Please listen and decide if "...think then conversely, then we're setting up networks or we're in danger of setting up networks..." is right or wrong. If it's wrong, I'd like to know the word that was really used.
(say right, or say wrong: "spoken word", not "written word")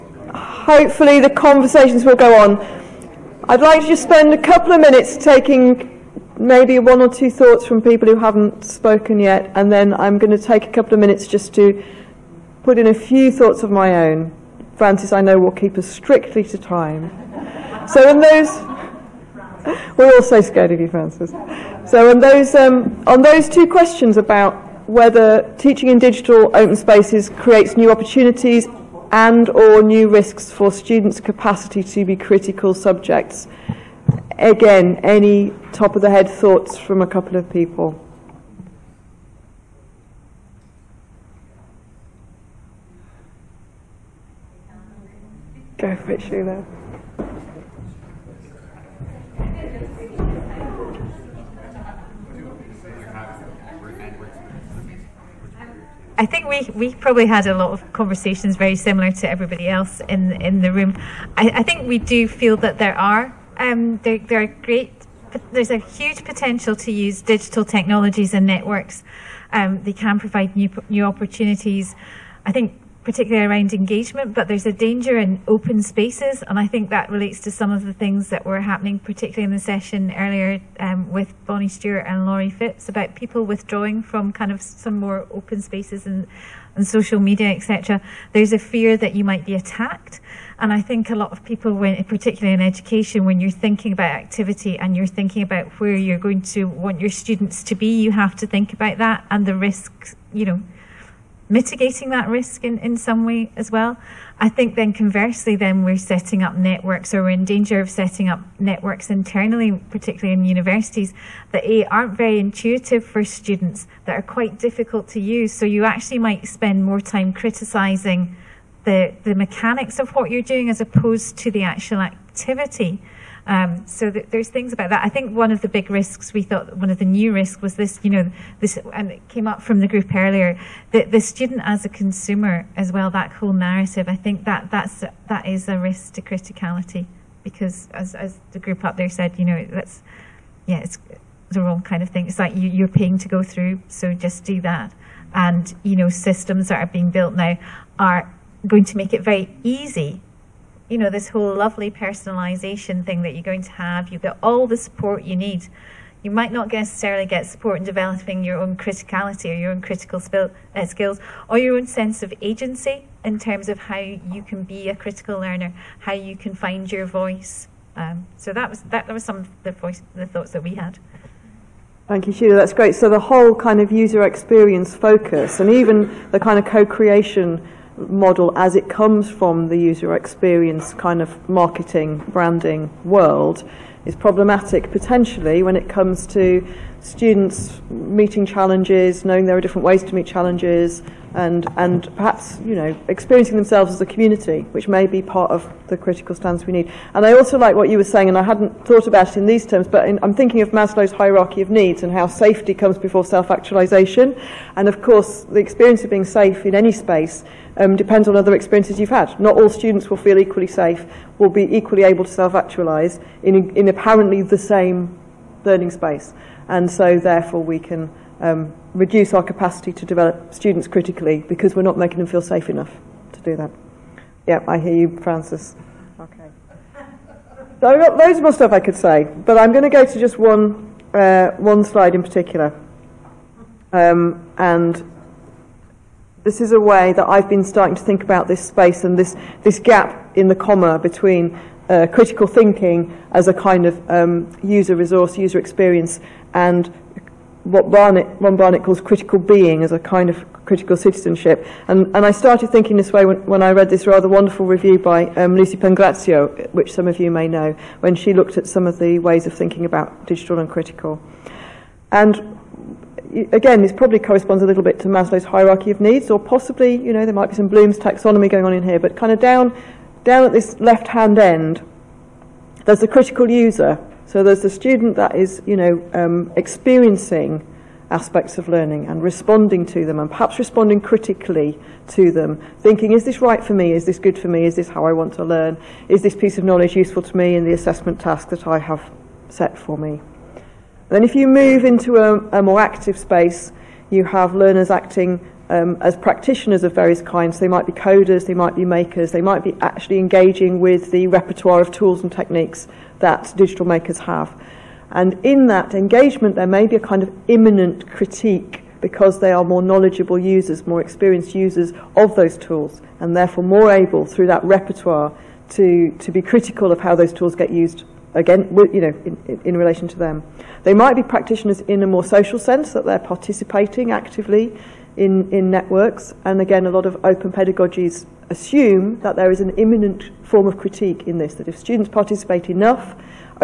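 right.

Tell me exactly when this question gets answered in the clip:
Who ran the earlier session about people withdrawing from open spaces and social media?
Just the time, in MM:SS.
01:21.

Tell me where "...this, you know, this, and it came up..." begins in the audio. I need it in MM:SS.
02:07.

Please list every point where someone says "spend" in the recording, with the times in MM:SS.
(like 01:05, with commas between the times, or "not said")
00:04, 01:56.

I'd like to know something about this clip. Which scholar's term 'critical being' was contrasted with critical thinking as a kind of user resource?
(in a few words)
Ron Barnett.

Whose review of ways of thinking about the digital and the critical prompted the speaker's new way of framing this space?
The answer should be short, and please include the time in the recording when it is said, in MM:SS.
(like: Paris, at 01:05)
Lucy Pangrazio, at 04:15.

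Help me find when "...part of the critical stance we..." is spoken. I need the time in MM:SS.
03:15.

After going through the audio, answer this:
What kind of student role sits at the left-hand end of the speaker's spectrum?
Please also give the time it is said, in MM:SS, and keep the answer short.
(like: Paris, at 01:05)
critical user, at 04:33.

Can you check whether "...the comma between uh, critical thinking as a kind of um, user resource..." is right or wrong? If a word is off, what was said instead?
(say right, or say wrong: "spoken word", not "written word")
right.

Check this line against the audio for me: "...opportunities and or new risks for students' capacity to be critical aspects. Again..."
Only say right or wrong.
wrong.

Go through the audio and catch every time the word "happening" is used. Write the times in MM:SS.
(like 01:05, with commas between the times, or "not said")
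01:18.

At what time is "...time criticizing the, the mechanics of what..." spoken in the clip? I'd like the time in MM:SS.
01:57.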